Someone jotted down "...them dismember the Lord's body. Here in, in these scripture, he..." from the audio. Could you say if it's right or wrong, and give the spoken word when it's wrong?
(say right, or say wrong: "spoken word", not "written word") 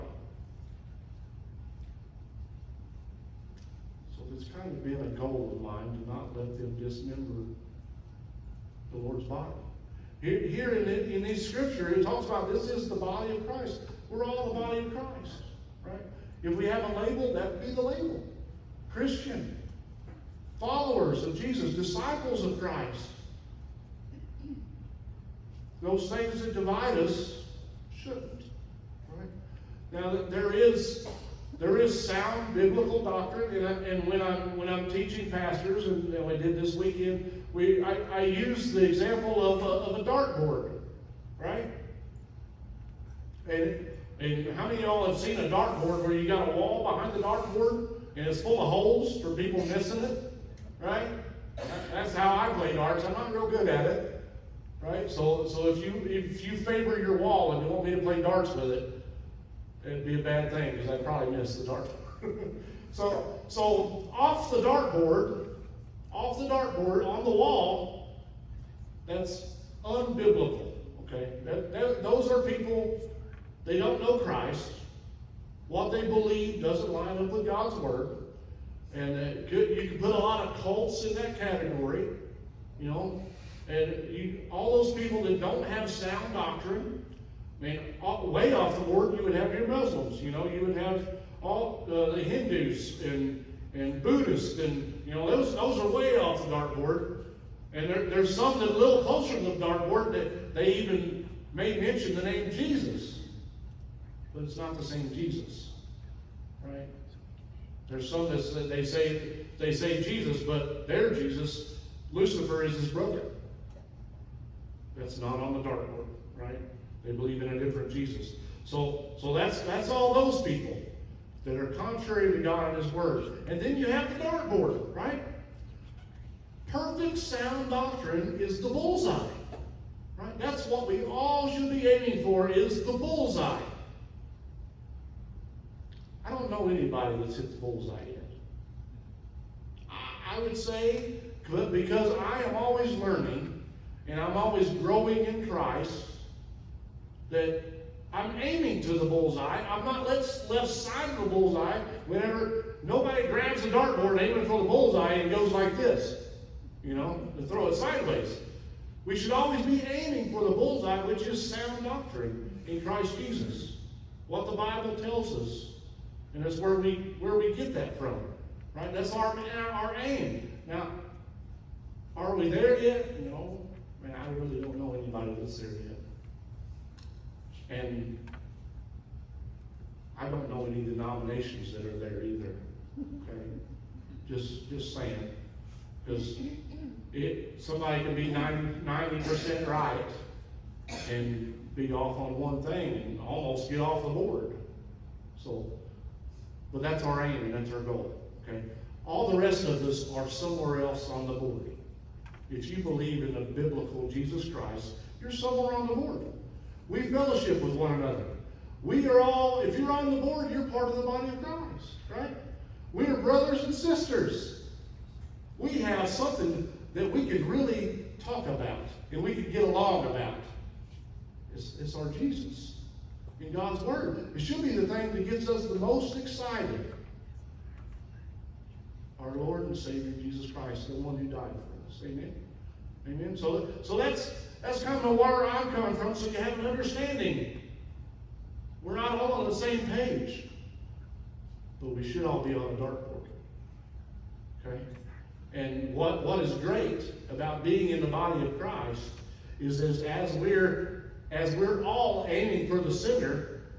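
right.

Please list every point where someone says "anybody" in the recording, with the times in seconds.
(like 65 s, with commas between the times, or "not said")
136 s, 174 s.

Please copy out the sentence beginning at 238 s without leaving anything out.
We're not all on the same page, but we should all be on a dartboard.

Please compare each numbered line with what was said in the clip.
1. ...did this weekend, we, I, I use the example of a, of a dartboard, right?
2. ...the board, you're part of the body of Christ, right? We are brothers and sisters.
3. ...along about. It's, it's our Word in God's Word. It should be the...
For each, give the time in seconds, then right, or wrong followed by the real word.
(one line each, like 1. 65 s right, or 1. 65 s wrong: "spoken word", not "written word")
1. 36 s right
2. 210 s right
3. 219 s wrong: "Jesus", not "Word".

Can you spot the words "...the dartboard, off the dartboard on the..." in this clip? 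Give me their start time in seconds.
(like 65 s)
64 s.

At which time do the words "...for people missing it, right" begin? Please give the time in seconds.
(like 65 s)
49 s.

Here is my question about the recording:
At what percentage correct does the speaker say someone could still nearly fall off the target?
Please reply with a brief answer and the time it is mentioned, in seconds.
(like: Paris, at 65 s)
90, at 188 s.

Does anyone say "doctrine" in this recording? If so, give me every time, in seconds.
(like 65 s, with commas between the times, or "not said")
33 s, 86 s, 127 s, 161 s.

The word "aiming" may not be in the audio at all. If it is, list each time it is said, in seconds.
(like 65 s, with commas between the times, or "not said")
131 s, 148 s, 154 s, 159 s, 252 s.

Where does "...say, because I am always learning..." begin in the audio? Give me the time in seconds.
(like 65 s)
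140 s.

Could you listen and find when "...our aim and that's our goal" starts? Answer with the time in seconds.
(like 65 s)
197 s.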